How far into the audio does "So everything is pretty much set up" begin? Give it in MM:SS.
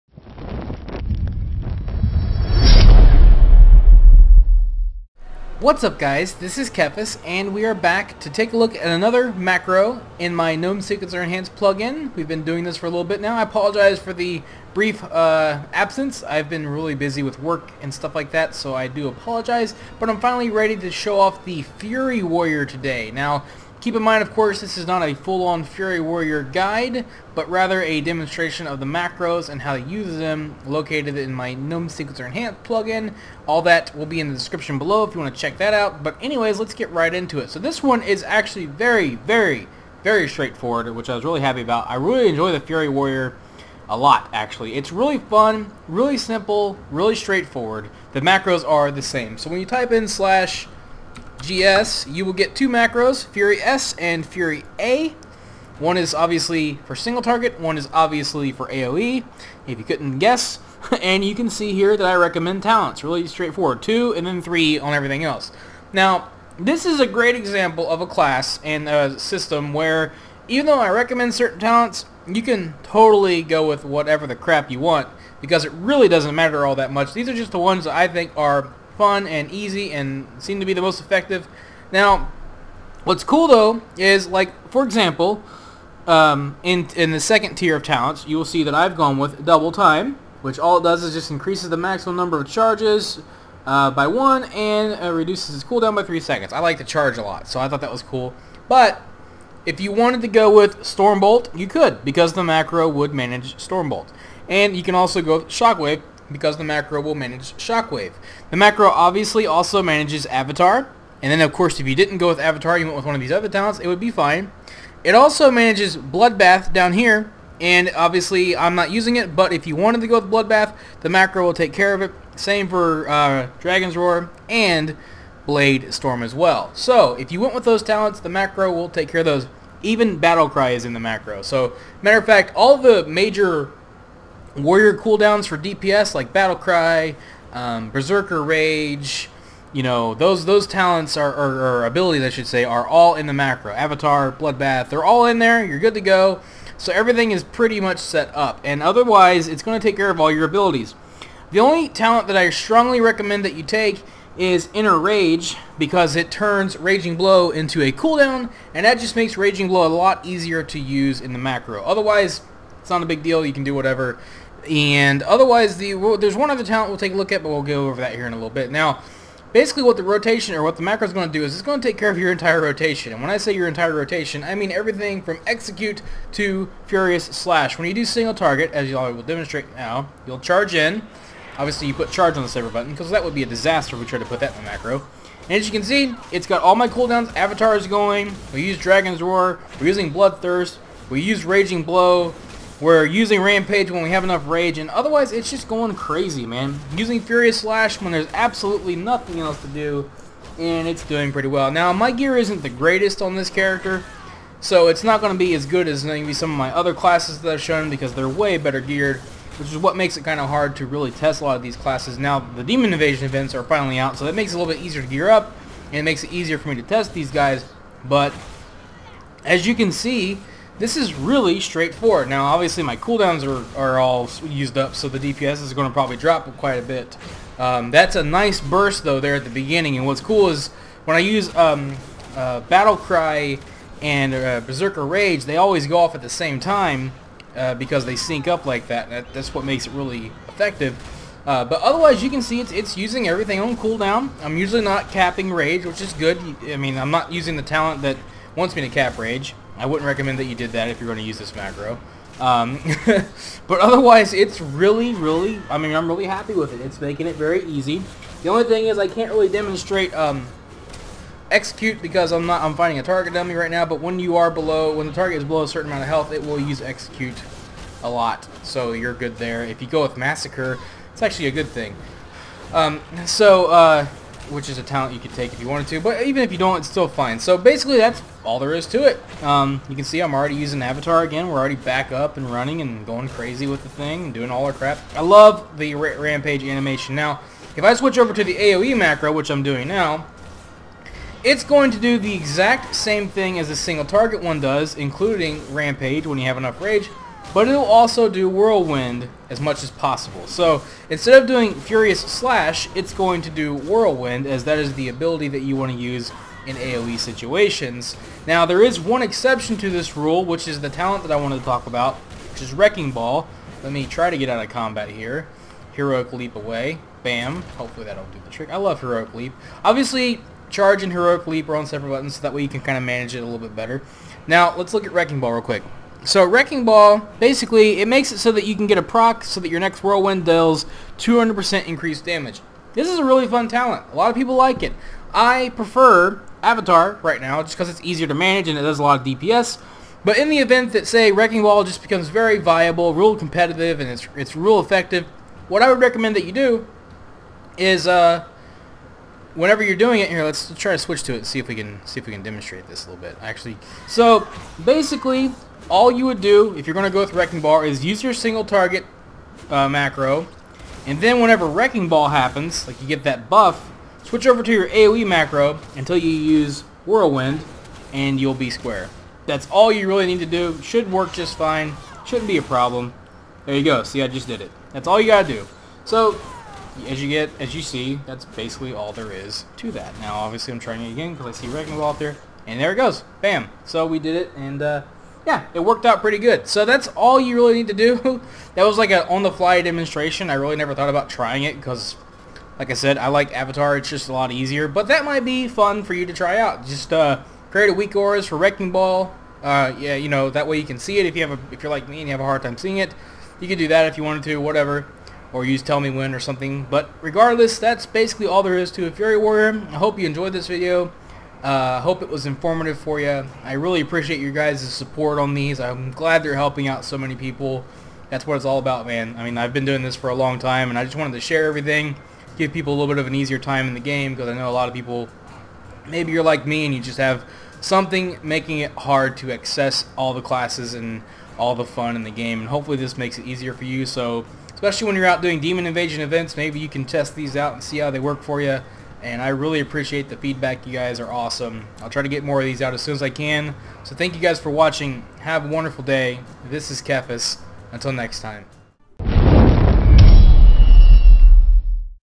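02:26.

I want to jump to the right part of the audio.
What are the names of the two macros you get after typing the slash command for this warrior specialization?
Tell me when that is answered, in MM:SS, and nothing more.
00:53.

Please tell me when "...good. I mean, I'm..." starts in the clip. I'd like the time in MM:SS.
04:06.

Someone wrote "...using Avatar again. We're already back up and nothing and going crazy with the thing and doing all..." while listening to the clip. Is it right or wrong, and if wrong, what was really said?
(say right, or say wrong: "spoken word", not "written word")
wrong: "running", not "nothing".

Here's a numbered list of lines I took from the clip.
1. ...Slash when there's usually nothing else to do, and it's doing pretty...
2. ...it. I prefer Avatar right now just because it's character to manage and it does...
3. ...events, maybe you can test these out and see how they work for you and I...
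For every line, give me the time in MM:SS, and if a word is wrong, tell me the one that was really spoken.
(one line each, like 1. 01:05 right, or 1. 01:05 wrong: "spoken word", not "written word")
1. 03:17 wrong: "absolutely", not "usually"
2. 05:34 wrong: "easier", not "character"
3. 07:16 right.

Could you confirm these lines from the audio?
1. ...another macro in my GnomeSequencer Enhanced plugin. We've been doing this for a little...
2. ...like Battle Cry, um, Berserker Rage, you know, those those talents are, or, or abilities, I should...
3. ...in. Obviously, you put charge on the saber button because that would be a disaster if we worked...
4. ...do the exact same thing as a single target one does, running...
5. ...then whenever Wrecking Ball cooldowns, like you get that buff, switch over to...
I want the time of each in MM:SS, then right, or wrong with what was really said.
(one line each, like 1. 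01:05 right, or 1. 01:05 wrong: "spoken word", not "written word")
1. 00:08 right
2. 02:16 right
3. 03:00 wrong: "tried", not "worked"
4. 04:51 wrong: "including", not "running"
5. 06:01 wrong: "happens", not "cooldowns".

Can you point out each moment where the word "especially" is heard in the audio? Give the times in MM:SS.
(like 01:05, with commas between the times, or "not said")
07:14.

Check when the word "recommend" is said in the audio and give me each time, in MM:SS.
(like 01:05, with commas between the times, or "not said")
01:02, 01:10, 02:32, 04:10, 05:45.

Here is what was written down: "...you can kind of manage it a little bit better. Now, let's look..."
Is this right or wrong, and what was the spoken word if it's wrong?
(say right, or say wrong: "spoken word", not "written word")
right.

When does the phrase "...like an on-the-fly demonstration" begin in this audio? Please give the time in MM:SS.
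06:28.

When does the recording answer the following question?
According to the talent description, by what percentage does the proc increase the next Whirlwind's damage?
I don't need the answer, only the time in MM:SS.
05:31.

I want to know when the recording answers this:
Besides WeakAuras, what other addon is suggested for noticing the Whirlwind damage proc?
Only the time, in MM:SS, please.
06:45.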